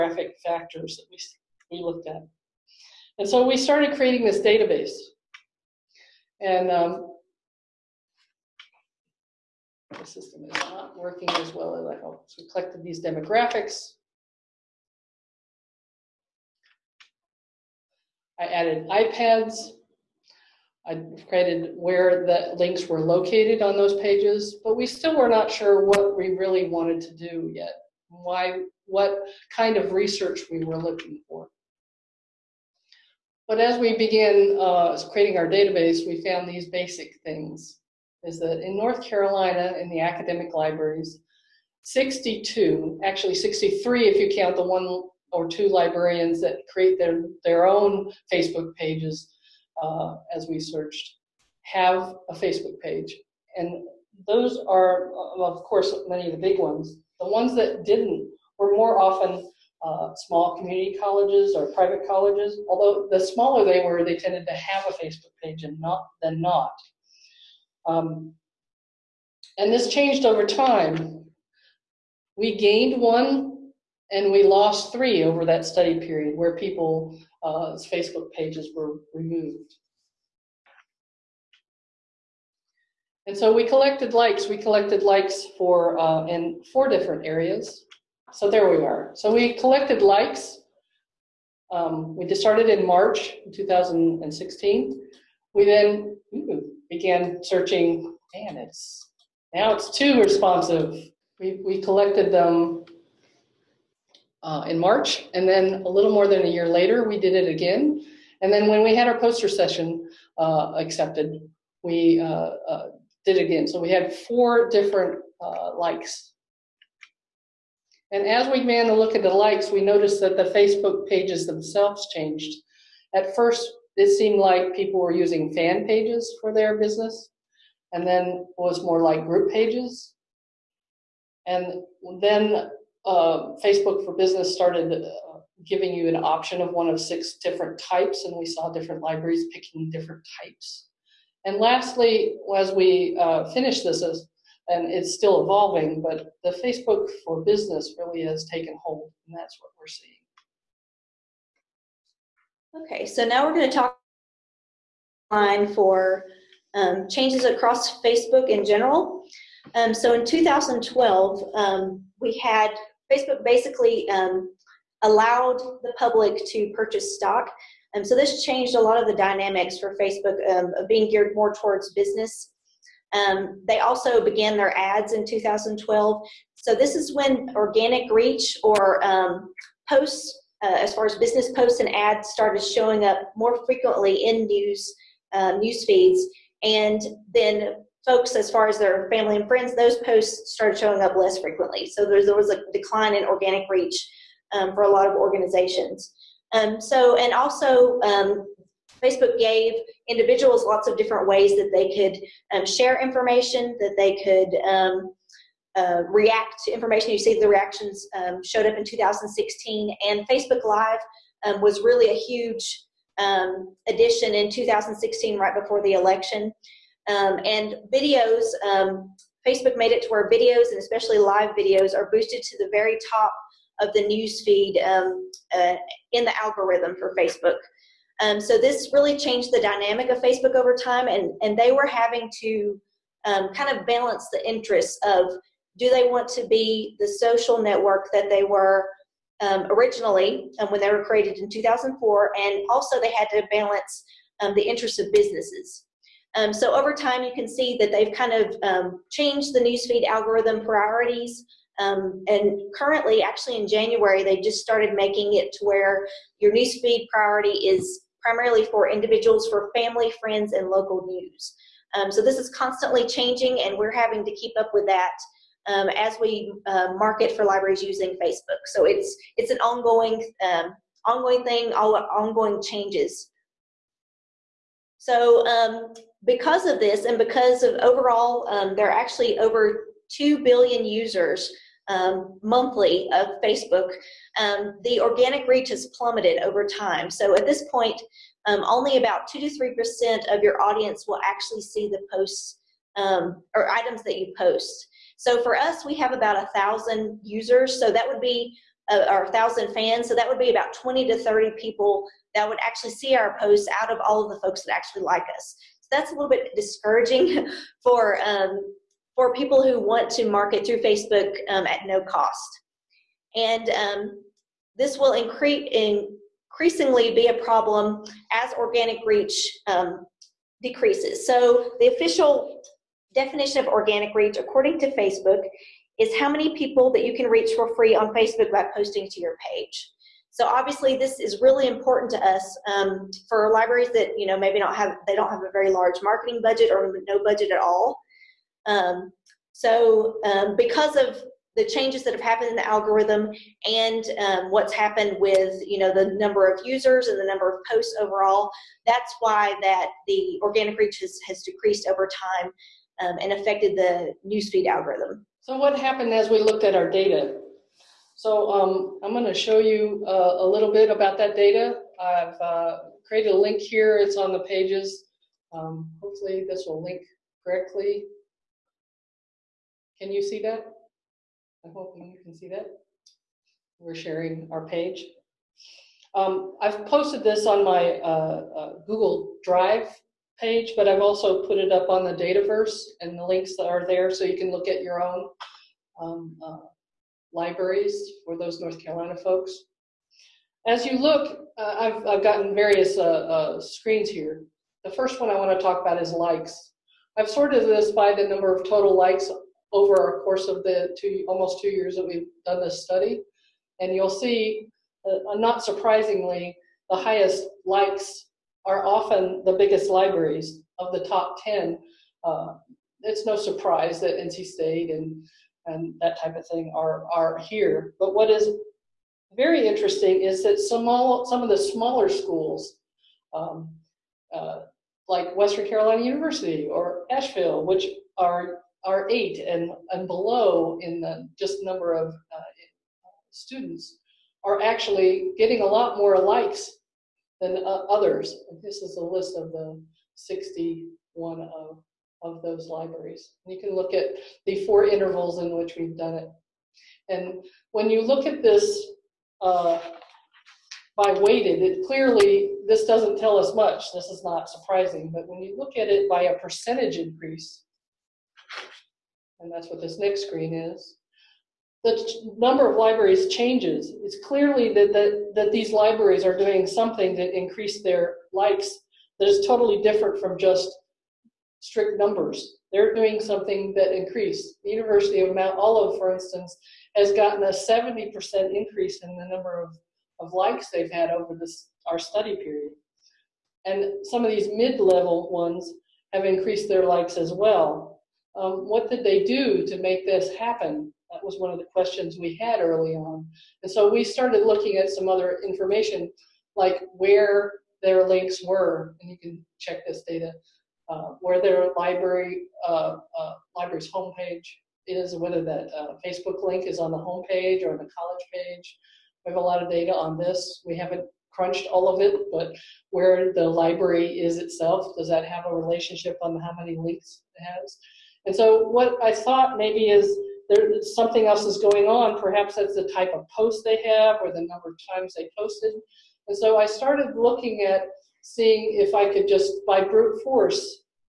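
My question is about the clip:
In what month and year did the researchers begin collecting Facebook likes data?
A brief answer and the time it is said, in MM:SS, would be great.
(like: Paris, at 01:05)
March 2016, at 01:32.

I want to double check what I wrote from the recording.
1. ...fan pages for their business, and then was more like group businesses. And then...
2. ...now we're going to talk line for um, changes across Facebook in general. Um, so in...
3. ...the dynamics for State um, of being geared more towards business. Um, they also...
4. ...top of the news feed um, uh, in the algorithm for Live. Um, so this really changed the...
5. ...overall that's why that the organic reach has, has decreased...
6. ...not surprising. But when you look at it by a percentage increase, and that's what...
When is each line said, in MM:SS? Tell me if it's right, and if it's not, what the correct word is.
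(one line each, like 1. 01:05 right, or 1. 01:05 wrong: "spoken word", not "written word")
1. 02:05 wrong: "pages", not "businesses"
2. 02:33 right
3. 02:49 wrong: "Facebook", not "State"
4. 03:43 wrong: "Facebook", not "Live"
5. 05:48 right
6. 07:34 right.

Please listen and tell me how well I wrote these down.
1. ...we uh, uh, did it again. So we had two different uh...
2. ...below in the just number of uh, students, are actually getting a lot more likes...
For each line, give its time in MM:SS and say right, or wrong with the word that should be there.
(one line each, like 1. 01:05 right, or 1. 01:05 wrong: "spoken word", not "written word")
1. 01:51 wrong: "four", not "two"
2. 07:10 right.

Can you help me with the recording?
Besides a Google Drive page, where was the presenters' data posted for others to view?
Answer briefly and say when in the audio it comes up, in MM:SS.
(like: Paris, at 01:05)
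Dataverse, at 06:22.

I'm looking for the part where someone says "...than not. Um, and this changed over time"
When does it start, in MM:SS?
01:06.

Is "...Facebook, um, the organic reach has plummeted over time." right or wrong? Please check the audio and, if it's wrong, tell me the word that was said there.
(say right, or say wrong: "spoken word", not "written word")
right.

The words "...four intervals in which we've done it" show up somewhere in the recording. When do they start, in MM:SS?
07:24.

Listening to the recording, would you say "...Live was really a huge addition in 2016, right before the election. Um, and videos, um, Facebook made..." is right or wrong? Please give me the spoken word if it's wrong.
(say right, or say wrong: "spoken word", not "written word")
right.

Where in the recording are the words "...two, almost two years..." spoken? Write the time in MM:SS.
06:40.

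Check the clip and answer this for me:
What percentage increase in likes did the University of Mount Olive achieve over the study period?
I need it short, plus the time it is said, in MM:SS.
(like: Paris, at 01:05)
70%, at 07:57.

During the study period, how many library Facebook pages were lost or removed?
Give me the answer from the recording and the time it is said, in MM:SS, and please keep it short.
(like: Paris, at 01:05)
3, at 01:14.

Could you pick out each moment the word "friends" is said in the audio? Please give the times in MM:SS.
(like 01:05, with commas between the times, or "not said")
03:09, 04:20.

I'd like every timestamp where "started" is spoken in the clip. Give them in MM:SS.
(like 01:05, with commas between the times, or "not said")
00:03, 01:32, 02:14, 03:02, 03:10, 04:14, 08:14, 08:46.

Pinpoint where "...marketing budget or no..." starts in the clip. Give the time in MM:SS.
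05:36.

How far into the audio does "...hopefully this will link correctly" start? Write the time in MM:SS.
06:06.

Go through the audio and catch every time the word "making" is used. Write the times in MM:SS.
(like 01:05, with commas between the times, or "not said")
04:14.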